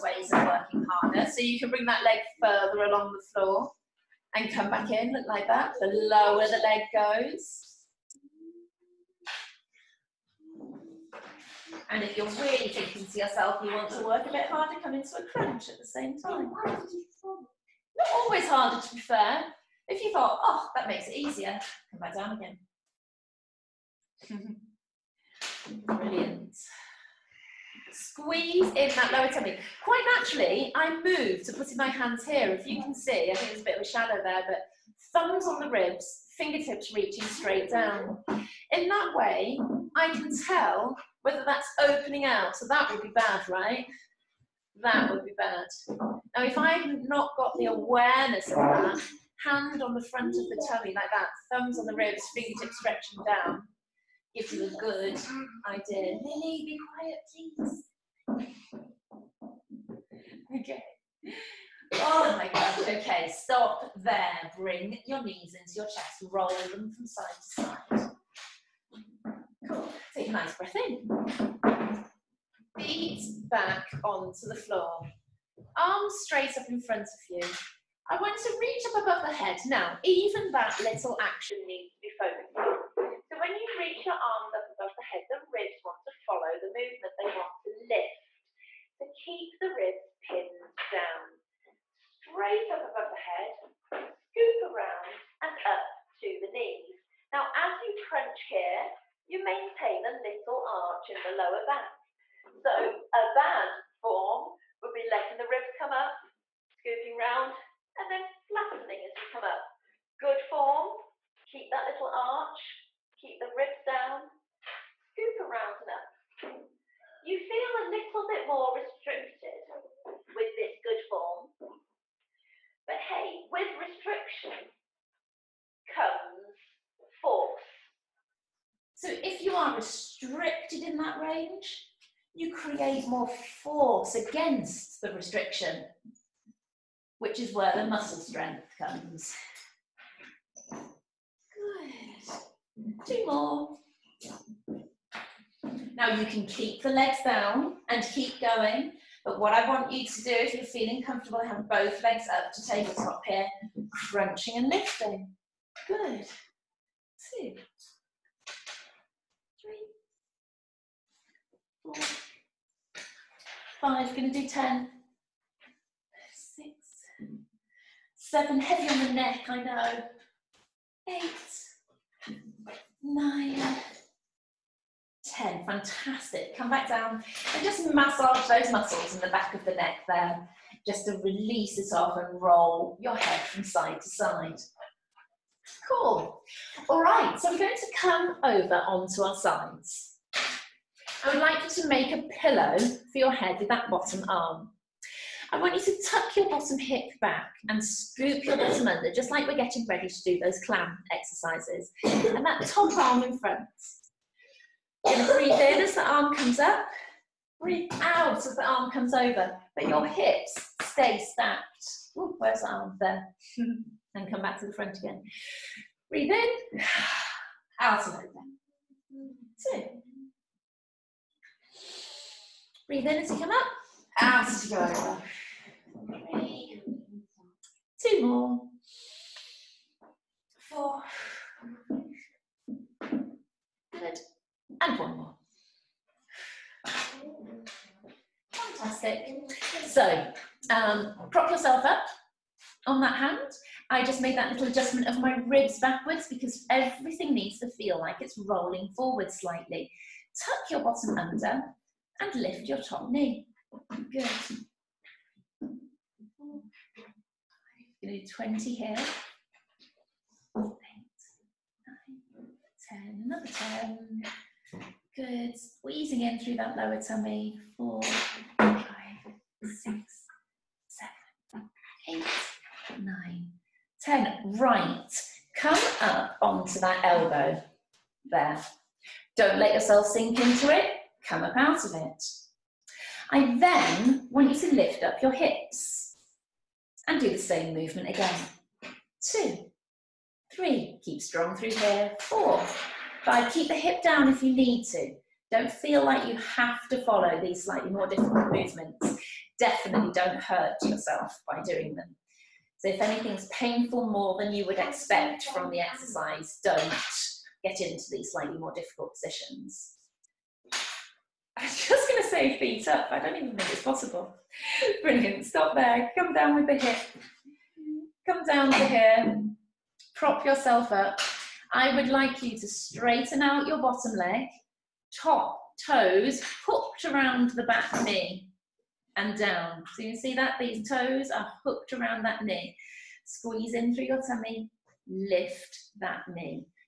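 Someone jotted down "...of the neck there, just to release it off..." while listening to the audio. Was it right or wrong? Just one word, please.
right.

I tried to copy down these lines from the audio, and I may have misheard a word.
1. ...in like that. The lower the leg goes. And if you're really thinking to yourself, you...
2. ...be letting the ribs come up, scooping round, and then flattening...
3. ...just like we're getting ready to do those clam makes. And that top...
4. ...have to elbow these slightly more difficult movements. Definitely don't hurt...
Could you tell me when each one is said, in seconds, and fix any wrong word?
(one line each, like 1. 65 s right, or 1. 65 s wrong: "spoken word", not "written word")
1. 4 s right
2. 104 s right
3. 199 s wrong: "exercises", not "makes"
4. 296 s wrong: "follow", not "elbow".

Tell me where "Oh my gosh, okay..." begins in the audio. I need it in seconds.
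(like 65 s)
61 s.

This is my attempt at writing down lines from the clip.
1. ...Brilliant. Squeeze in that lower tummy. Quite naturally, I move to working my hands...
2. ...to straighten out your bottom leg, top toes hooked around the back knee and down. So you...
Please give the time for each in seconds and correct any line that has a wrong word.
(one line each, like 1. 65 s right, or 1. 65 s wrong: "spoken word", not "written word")
1. 25 s wrong: "putting", not "working"
2. 322 s right.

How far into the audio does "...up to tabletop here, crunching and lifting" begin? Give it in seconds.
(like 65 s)
152 s.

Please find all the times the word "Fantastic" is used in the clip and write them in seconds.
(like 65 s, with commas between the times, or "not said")
175 s, 238 s.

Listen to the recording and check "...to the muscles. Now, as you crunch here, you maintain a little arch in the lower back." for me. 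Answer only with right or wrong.
wrong.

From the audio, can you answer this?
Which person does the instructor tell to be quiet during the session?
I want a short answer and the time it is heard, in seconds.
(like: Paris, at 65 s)
Lily, at 56 s.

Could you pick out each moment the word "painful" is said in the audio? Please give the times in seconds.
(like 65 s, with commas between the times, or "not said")
303 s.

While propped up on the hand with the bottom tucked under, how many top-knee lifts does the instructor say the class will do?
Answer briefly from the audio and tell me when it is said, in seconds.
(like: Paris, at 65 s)
20, at 255 s.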